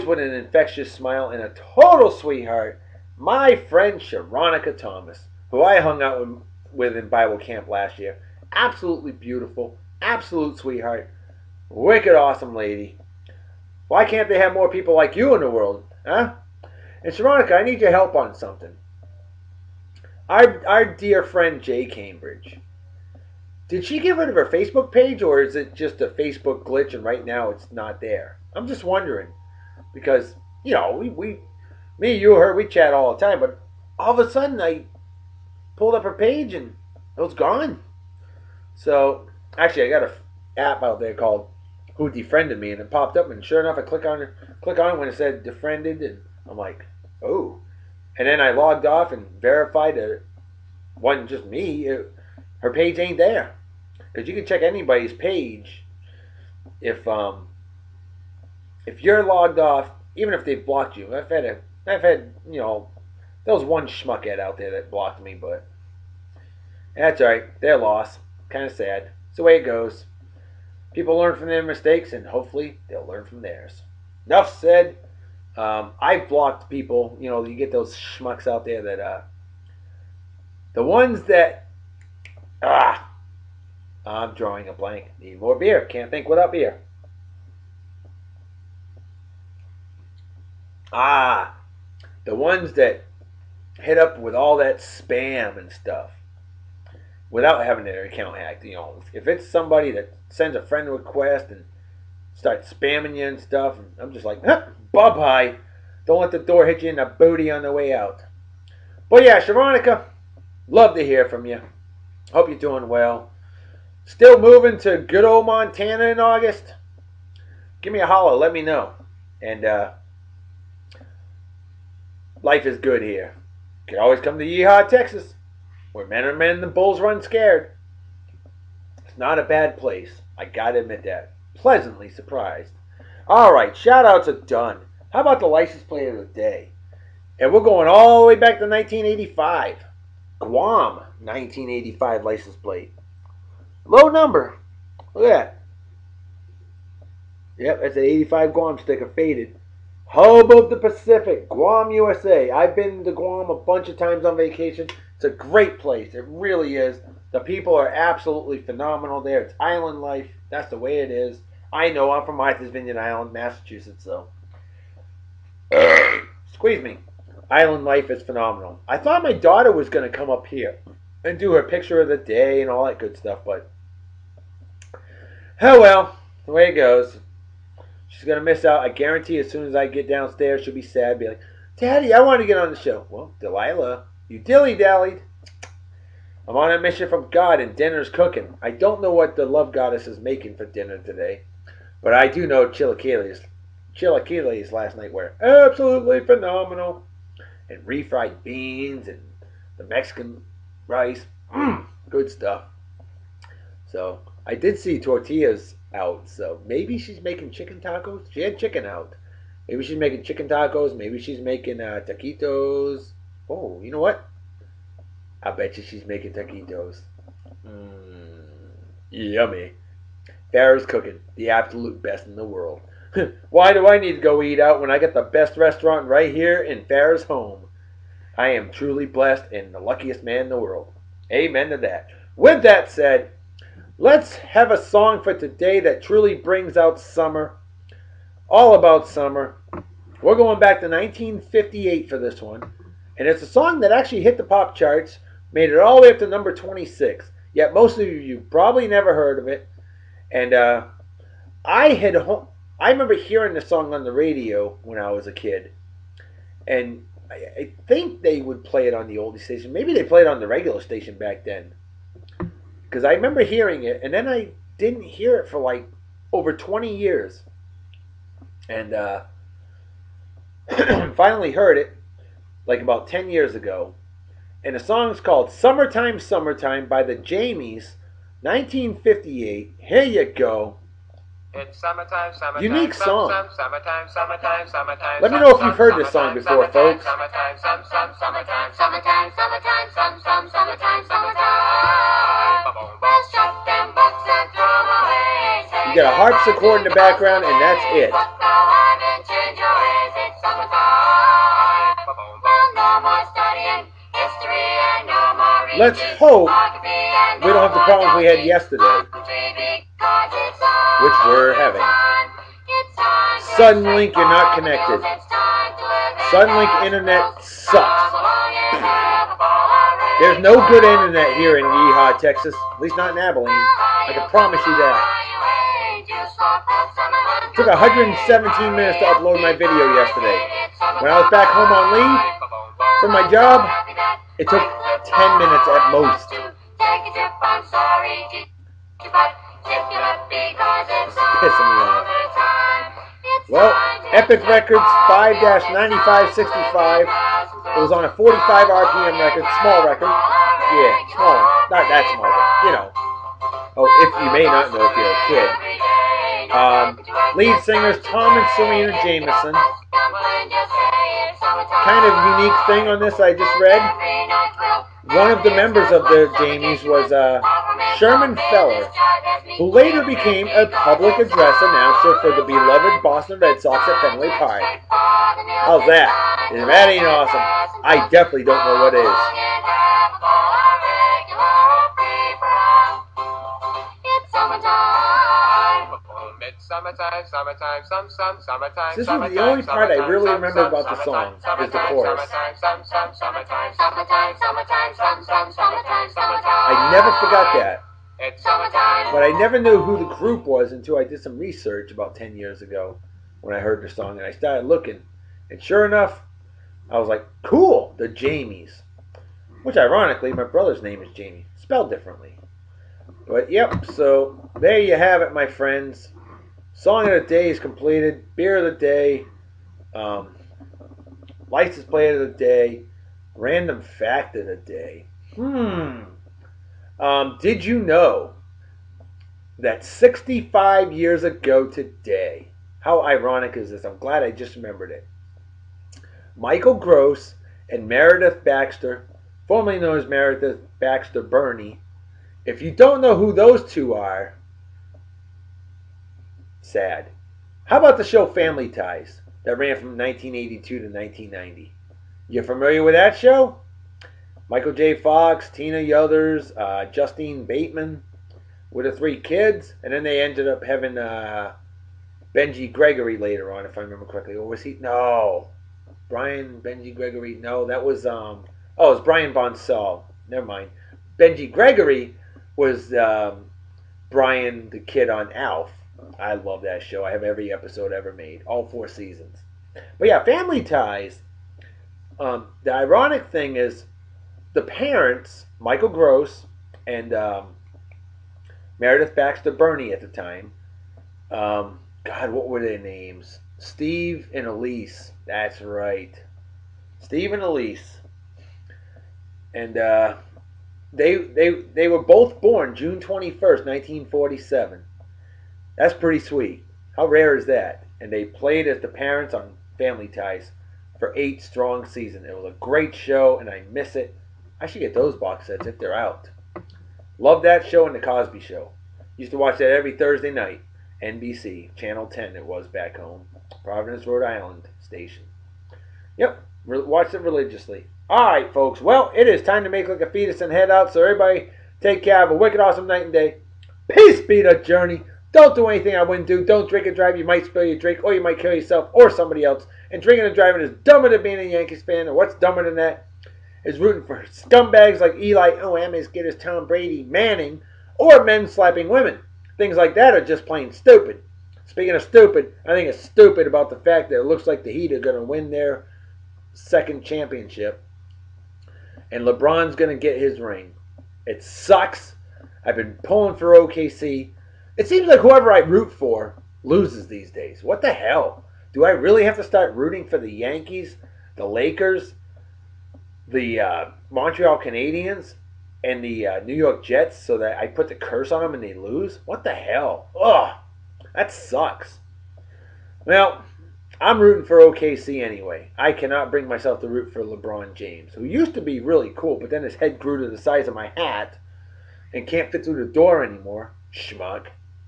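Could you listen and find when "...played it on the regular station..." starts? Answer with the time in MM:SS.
04:20.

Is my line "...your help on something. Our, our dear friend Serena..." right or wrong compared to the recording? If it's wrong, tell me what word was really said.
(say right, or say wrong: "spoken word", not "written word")
wrong: "Jay", not "Serena".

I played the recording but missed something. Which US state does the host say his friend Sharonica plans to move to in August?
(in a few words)
Montana.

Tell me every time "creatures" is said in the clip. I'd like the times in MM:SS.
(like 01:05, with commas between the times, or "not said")
not said.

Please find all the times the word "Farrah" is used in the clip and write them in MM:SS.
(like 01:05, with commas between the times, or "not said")
03:40, 03:46.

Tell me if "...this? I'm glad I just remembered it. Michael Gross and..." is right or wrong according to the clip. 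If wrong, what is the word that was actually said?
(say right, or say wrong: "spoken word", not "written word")
right.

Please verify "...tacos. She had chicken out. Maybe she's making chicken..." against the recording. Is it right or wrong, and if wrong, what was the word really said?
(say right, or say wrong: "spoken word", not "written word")
right.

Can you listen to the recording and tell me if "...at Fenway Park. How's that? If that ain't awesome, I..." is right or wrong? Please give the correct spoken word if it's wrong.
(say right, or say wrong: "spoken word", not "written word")
right.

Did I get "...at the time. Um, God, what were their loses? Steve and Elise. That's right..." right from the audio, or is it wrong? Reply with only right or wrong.
wrong.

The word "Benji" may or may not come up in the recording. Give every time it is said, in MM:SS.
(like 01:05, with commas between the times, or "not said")
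07:42, 07:46, 07:51.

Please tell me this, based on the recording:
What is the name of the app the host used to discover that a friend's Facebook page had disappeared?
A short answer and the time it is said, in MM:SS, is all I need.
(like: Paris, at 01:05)
Who Defriended Me, at 00:41.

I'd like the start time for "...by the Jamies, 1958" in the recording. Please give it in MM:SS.
04:36.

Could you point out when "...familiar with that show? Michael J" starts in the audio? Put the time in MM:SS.
07:32.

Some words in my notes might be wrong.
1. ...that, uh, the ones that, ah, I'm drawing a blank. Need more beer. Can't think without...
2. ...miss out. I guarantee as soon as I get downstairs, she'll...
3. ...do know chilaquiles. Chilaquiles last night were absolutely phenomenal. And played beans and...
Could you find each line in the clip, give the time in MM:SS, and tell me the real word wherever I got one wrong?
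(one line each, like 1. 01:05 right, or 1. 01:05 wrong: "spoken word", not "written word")
1. 01:18 right
2. 02:58 right
3. 03:12 wrong: "refried", not "played".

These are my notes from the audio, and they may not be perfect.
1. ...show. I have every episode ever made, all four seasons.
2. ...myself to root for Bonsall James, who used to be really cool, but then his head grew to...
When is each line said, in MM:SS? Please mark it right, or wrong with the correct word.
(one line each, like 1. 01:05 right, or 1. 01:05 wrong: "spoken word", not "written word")
1. 07:56 right
2. 09:46 wrong: "LeBron", not "Bonsall".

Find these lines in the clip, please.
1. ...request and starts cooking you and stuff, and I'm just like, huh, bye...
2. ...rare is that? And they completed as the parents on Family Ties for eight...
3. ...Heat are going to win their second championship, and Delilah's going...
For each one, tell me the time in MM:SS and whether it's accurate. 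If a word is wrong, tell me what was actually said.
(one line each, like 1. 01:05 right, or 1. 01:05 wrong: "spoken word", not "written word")
1. 01:40 wrong: "spamming", not "cooking"
2. 08:27 wrong: "played", not "completed"
3. 09:14 wrong: "LeBron", not "Delilah".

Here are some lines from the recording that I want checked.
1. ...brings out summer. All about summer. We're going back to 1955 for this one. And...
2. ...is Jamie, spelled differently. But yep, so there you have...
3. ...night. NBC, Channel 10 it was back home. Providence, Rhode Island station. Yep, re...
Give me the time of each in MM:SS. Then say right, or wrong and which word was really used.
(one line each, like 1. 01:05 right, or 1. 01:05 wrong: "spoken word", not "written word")
1. 03:56 wrong: "1958", not "1955"
2. 06:51 right
3. 08:40 right.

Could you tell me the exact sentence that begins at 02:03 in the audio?
You can always come to Yeehaw, Texas.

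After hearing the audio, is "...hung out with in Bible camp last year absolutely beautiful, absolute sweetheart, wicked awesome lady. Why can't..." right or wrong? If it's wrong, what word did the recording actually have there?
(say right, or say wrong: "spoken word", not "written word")
right.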